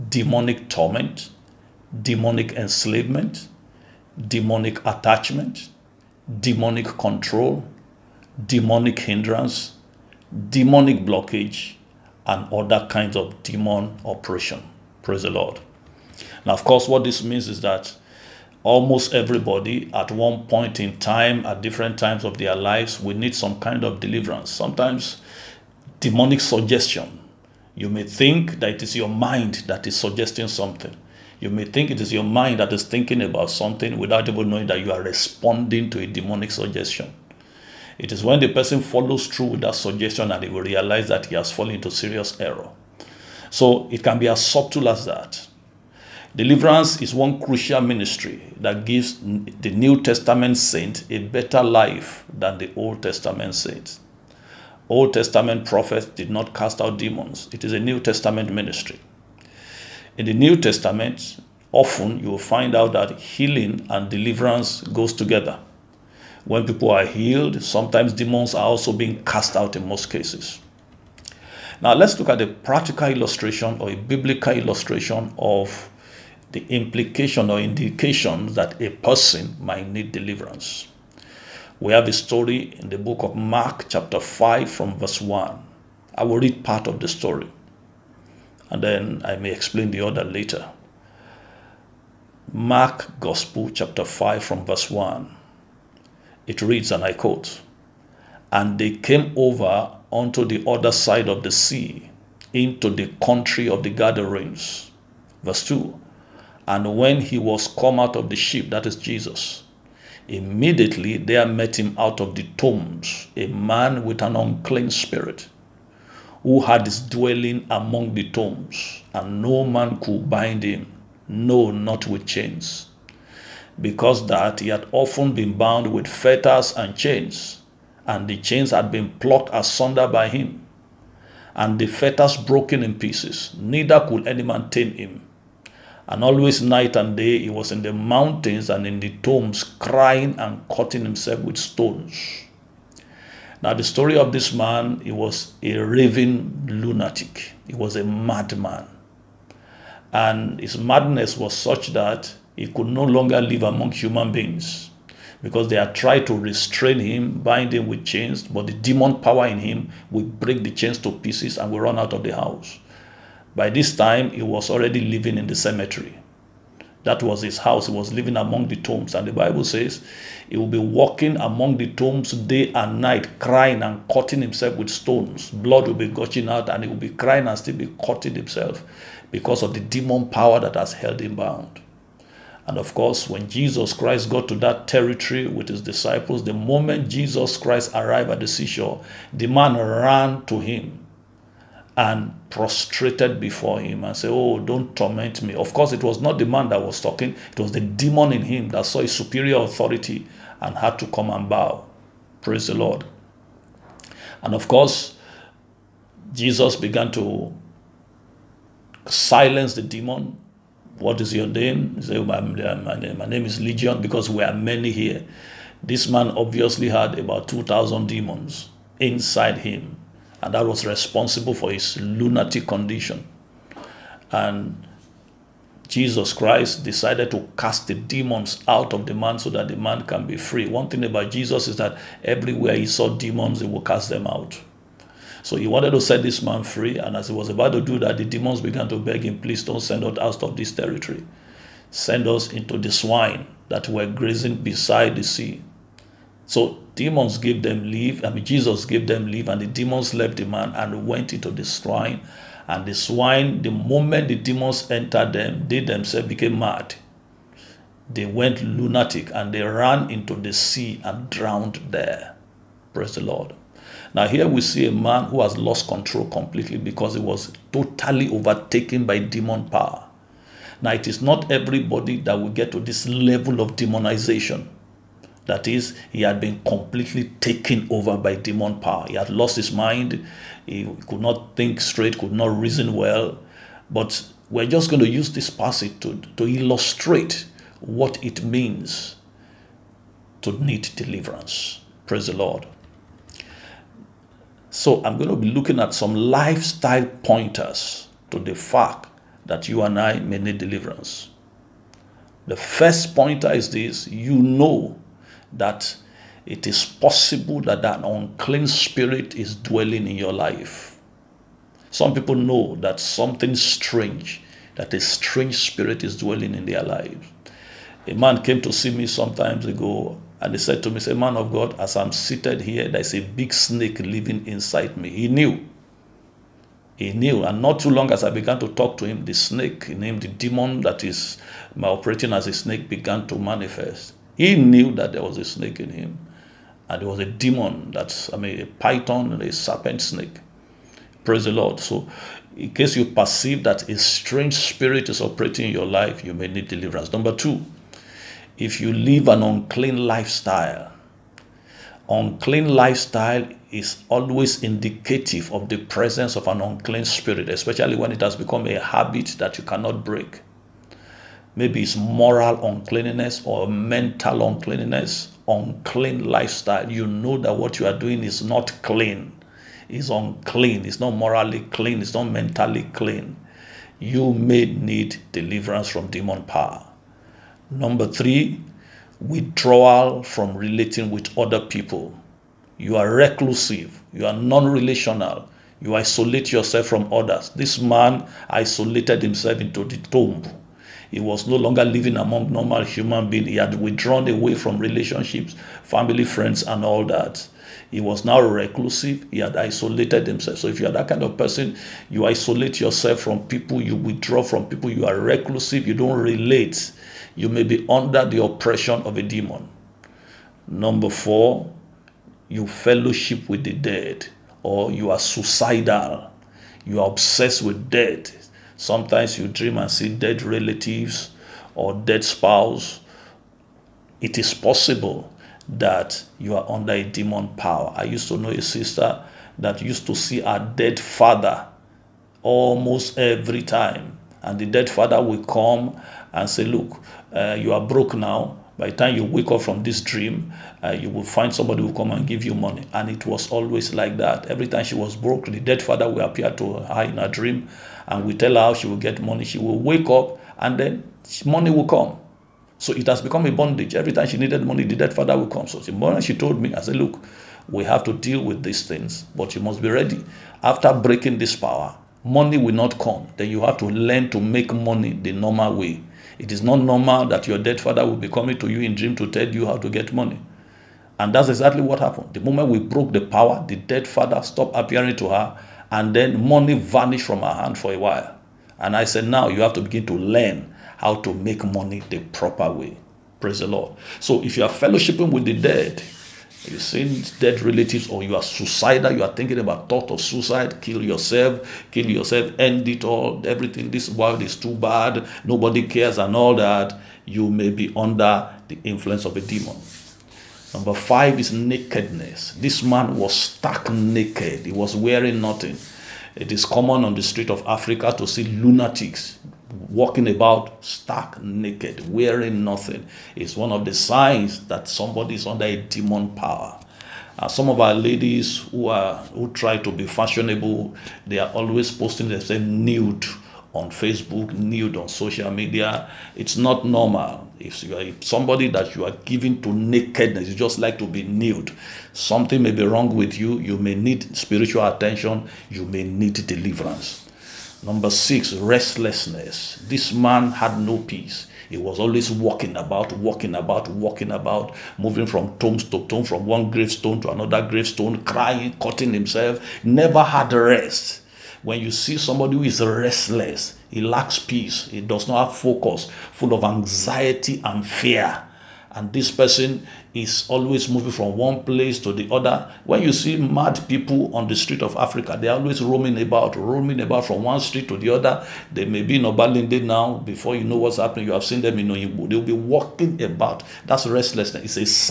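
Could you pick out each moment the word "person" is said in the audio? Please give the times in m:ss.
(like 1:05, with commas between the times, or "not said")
0:38, 1:18, 6:41, 9:19.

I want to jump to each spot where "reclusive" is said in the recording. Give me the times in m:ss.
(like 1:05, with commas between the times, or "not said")
6:23, 6:38, 6:45.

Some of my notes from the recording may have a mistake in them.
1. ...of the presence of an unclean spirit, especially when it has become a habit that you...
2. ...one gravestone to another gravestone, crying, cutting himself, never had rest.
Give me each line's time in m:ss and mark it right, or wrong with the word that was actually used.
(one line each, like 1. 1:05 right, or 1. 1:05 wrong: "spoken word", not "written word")
1. 5:55 right
2. 9:06 right.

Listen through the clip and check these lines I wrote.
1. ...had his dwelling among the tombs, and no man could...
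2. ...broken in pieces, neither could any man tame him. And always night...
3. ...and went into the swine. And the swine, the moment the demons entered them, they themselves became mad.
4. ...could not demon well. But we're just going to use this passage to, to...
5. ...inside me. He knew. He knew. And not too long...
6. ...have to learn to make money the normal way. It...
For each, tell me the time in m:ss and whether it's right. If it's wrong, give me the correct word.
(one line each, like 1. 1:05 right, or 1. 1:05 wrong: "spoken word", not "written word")
1. 1:56 right
2. 2:12 right
3. 4:10 right
4. 4:42 wrong: "reason", not "demon"
5. 5:24 right
6. 7:43 right.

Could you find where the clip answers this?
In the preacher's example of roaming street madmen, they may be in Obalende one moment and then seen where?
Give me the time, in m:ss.
9:31.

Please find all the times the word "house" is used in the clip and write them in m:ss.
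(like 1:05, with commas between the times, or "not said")
2:42, 2:47.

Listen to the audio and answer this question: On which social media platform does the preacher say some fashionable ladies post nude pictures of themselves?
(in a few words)
Facebook.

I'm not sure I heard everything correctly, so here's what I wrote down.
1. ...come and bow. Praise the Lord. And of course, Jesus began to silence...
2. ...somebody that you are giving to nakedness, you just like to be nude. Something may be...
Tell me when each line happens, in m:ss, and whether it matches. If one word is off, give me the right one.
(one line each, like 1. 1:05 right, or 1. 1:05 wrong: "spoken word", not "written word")
1. 3:21 right
2. 8:48 right.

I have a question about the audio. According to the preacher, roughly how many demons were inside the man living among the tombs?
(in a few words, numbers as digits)
2000.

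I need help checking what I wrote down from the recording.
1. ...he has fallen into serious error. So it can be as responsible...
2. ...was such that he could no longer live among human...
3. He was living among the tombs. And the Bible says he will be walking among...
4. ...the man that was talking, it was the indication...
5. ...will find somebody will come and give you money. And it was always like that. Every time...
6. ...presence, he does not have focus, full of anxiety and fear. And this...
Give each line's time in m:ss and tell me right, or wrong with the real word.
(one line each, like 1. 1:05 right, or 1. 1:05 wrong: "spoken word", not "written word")
1. 0:41 wrong: "subtle", not "responsible"
2. 2:31 right
3. 2:47 right
4. 3:16 wrong: "demon", not "indication"
5. 7:21 right
6. 9:14 wrong: "peace", not "presence".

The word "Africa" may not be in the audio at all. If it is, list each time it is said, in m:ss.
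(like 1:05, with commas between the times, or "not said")
8:27, 9:24.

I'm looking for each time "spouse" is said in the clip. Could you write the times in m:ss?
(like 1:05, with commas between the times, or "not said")
7:02.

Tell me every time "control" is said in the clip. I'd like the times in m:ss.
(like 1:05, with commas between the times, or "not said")
0:06, 4:25.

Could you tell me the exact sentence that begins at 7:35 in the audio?
So the morning she told me, I said, Look, we have to deal with these things, but you must be ready.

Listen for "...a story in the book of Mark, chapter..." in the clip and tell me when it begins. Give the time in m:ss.
1:22.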